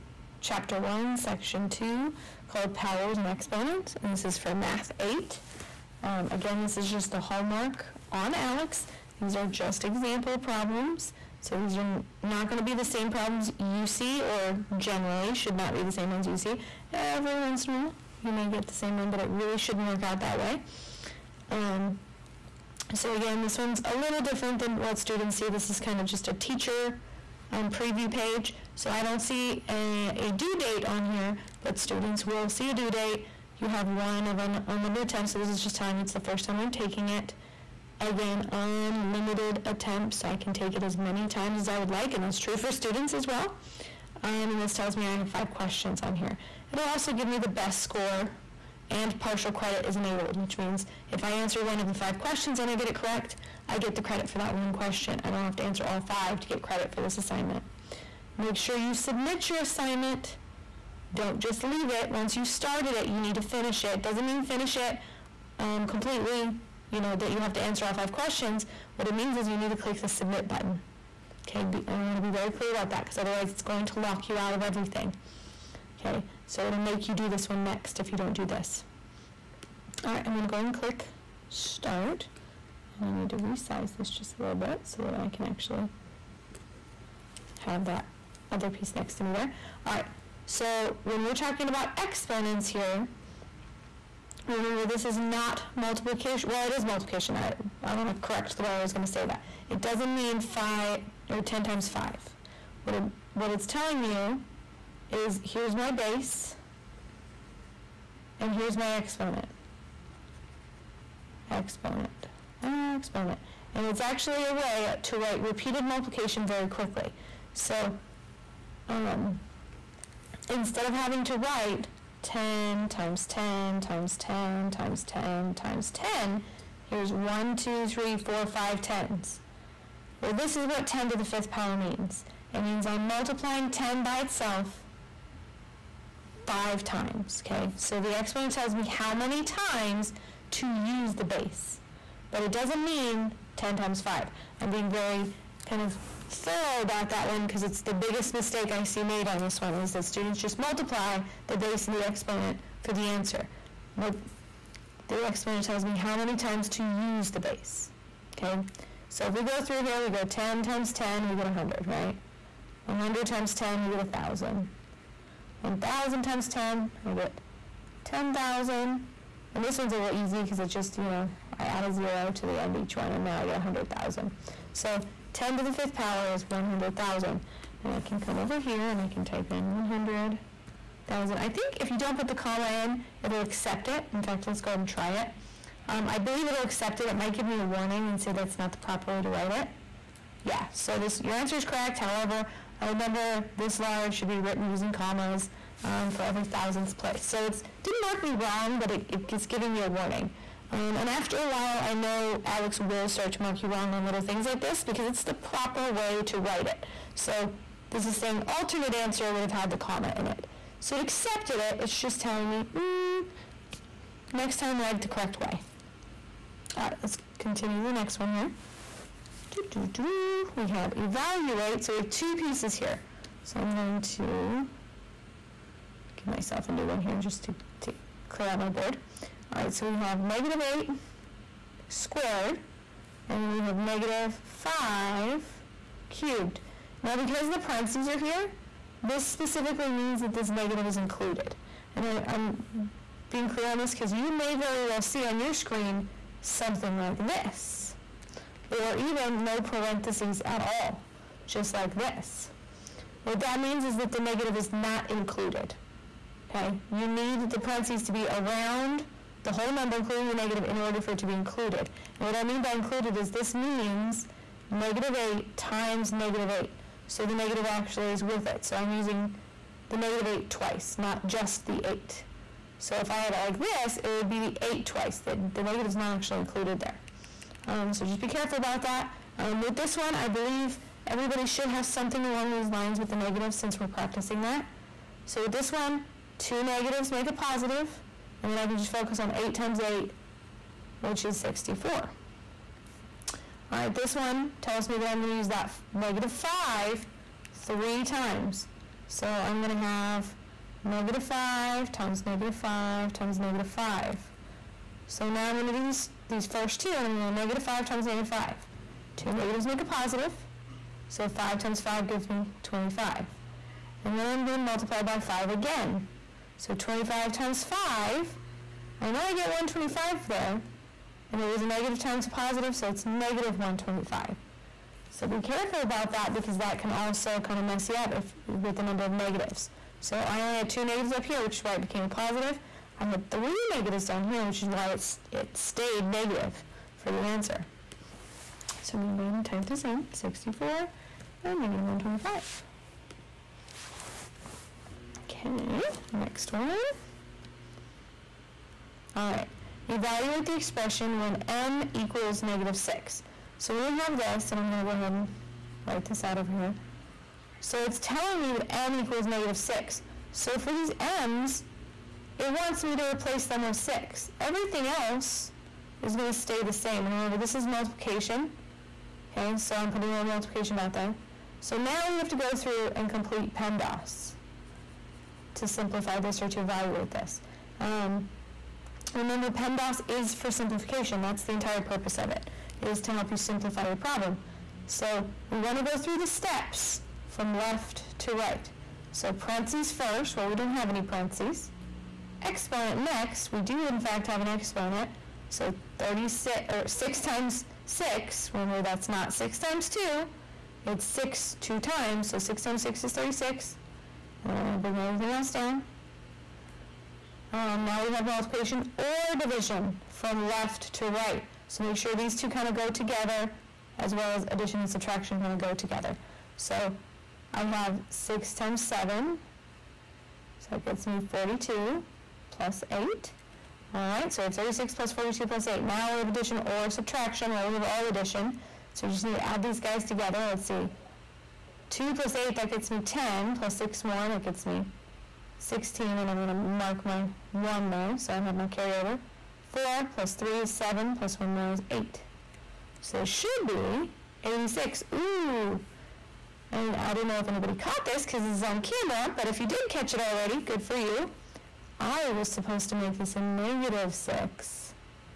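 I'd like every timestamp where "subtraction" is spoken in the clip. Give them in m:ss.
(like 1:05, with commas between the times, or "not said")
6:54, 7:06.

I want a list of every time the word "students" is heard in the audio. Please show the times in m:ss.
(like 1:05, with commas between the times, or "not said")
0:24, 0:31, 0:42, 2:30.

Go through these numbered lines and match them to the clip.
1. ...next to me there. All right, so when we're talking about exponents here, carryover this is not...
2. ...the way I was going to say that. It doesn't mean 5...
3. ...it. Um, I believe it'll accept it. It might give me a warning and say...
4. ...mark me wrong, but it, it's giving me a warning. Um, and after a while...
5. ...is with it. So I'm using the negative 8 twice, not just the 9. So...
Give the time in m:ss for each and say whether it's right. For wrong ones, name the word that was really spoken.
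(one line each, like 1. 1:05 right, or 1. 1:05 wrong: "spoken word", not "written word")
1. 1:28 wrong: "remember", not "carryover"
2. 1:38 right
3. 3:05 right
4. 3:18 right
5. 4:28 wrong: "8", not "9".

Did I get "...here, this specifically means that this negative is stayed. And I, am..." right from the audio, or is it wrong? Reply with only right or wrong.
wrong.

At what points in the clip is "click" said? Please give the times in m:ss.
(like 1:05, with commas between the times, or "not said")
1:09, 1:20.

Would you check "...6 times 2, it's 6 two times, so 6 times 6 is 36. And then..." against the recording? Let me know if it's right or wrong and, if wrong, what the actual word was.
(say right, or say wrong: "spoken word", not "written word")
right.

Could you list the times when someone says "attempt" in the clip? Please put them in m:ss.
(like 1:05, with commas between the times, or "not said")
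0:35, 0:39.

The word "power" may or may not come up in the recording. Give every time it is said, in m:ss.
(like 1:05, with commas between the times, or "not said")
0:02, 2:11, 2:55.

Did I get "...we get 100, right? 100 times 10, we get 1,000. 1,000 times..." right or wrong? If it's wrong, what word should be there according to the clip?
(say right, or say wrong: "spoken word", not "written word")
right.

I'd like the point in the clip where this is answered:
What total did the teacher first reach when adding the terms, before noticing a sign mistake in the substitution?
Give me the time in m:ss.
7:24.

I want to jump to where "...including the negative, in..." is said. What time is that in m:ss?
4:19.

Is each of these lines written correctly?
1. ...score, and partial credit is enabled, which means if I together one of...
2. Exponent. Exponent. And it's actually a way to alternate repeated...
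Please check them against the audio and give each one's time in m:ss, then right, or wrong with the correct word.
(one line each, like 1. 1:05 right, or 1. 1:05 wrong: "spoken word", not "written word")
1. 0:47 wrong: "answer", not "together"
2. 1:51 wrong: "write", not "alternate".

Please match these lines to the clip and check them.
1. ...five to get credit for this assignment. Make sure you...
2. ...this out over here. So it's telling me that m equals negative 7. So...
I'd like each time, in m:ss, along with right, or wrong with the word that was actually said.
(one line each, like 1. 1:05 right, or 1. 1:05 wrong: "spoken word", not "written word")
1. 0:56 right
2. 5:56 wrong: "6", not "7".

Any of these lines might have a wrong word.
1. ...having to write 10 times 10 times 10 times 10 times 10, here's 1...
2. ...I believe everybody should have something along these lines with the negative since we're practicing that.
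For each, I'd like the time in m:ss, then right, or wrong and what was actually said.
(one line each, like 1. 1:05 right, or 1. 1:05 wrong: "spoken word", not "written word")
1. 2:00 right
2. 4:40 right.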